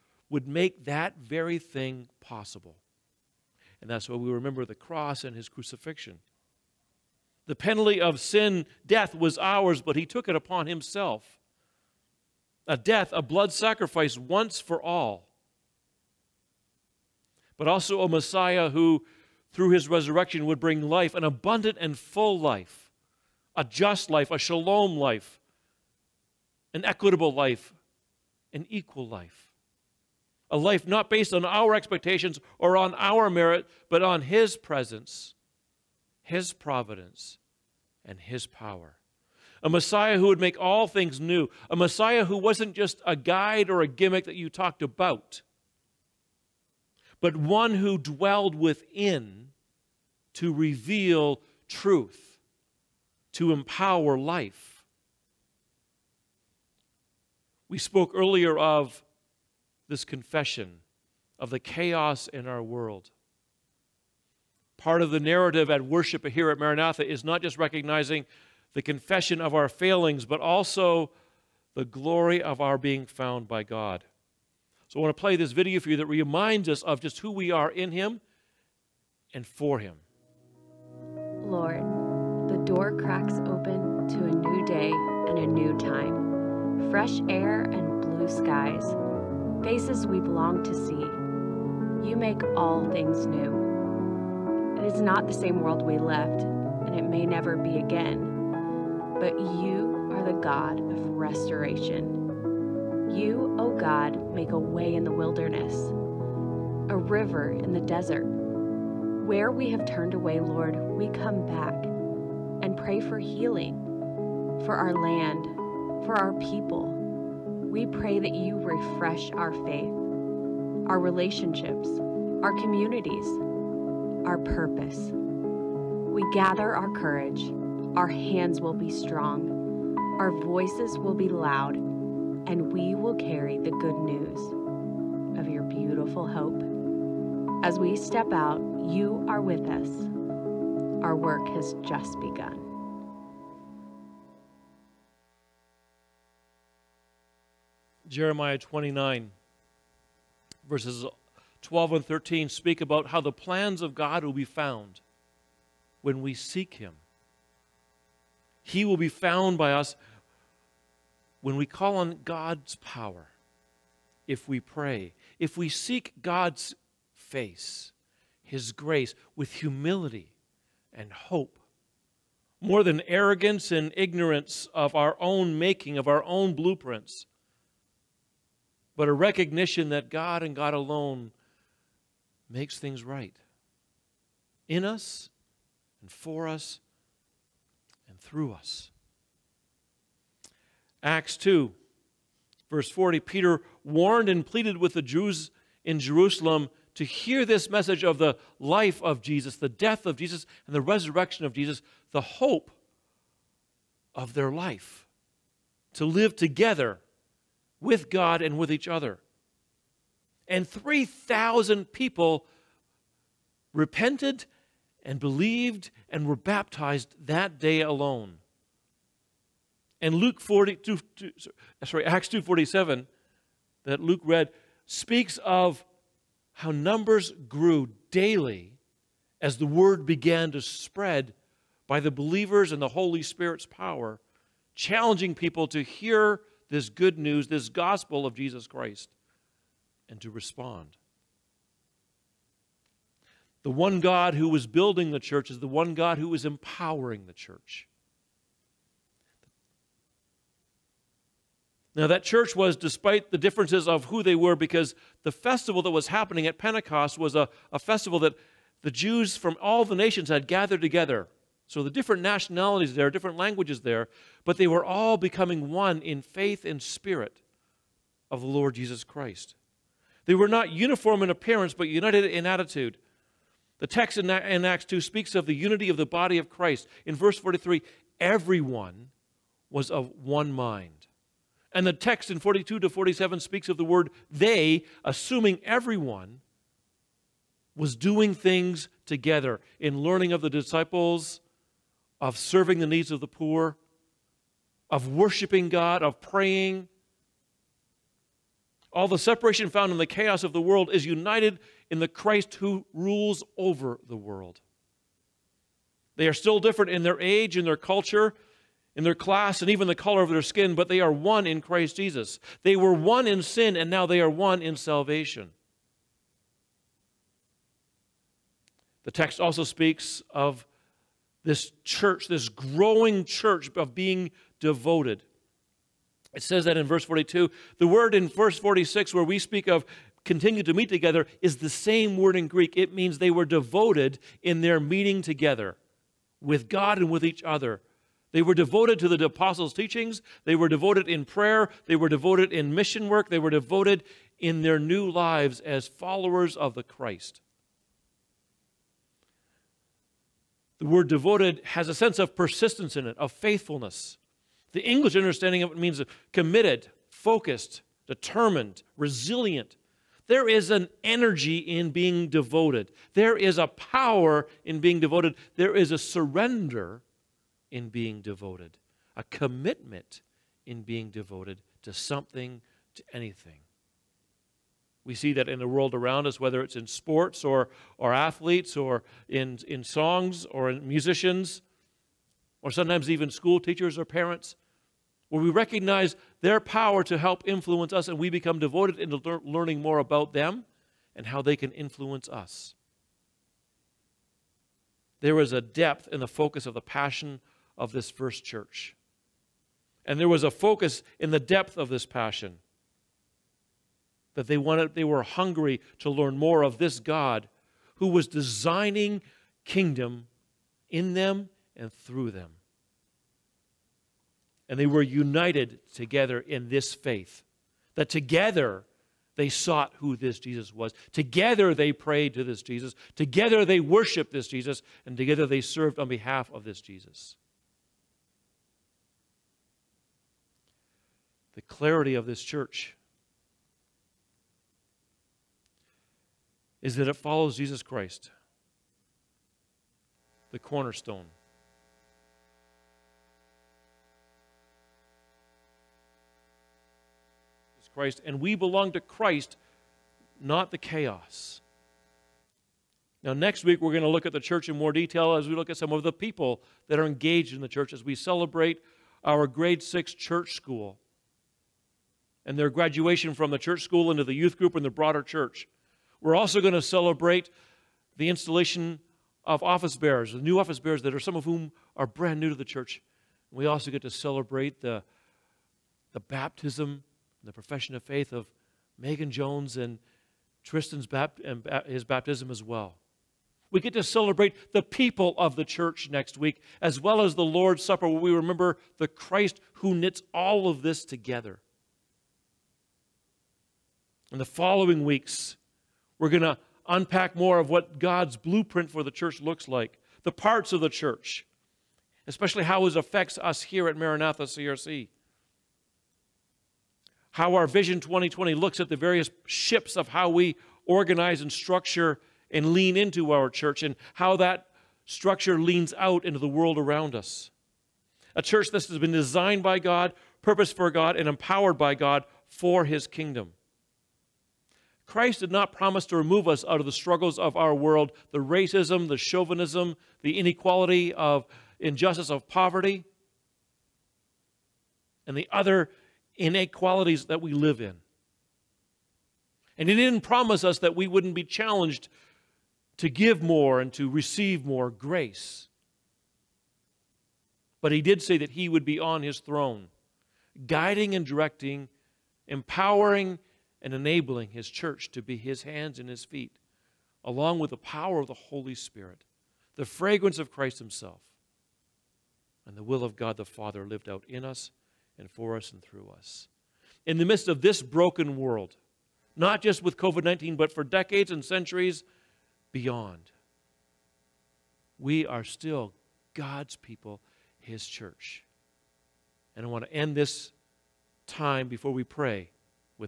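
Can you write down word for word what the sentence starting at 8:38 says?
A church that has been designed by God, purposed for God, and empowered by God for His kingdom.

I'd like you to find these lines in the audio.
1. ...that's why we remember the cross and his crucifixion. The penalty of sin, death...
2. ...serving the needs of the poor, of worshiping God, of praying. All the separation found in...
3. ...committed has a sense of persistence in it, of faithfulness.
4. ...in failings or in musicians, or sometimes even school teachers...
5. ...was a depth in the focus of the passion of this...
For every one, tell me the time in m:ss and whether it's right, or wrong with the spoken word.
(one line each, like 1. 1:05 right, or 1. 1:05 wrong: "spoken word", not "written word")
1. 0:03 right
2. 4:52 right
3. 5:51 wrong: "devoted", not "committed"
4. 6:19 wrong: "songs", not "failings"
5. 6:35 right.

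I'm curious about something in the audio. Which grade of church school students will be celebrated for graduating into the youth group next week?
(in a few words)
Grade six.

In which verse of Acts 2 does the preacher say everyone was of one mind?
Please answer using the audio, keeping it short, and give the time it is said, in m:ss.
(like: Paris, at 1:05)
Verse 43, at 4:37.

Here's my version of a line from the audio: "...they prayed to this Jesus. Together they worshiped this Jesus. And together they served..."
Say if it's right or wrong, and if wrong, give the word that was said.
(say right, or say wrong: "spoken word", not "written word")
right.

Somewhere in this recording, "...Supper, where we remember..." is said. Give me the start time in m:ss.
8:07.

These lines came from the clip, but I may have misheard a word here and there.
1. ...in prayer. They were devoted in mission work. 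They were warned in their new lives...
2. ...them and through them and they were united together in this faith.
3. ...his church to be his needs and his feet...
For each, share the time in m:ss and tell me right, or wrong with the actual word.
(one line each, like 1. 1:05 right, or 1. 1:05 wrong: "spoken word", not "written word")
1. 5:41 wrong: "devoted", not "warned"
2. 6:51 right
3. 9:14 wrong: "hands", not "needs".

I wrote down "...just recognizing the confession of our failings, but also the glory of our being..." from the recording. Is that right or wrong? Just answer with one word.
right.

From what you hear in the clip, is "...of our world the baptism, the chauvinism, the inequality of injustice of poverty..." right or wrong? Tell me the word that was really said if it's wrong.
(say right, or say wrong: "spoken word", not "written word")
wrong: "racism", not "baptism".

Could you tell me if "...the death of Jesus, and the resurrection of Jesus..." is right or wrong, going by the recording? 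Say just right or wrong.
right.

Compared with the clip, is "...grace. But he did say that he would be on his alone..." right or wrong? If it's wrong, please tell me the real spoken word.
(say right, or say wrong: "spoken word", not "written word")
wrong: "throne", not "alone".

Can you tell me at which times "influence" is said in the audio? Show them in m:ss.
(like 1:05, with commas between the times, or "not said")
6:27, 6:31.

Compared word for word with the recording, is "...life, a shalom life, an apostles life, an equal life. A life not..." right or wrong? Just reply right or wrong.
wrong.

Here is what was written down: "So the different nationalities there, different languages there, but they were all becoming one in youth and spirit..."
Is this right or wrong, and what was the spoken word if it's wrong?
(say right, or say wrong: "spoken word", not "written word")
wrong: "faith", not "youth".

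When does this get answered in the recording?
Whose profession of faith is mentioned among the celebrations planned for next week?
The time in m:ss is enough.
7:58.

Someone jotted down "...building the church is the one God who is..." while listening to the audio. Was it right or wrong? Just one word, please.
right.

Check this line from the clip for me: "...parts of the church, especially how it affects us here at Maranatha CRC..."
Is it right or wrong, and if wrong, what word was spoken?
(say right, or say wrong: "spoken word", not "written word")
right.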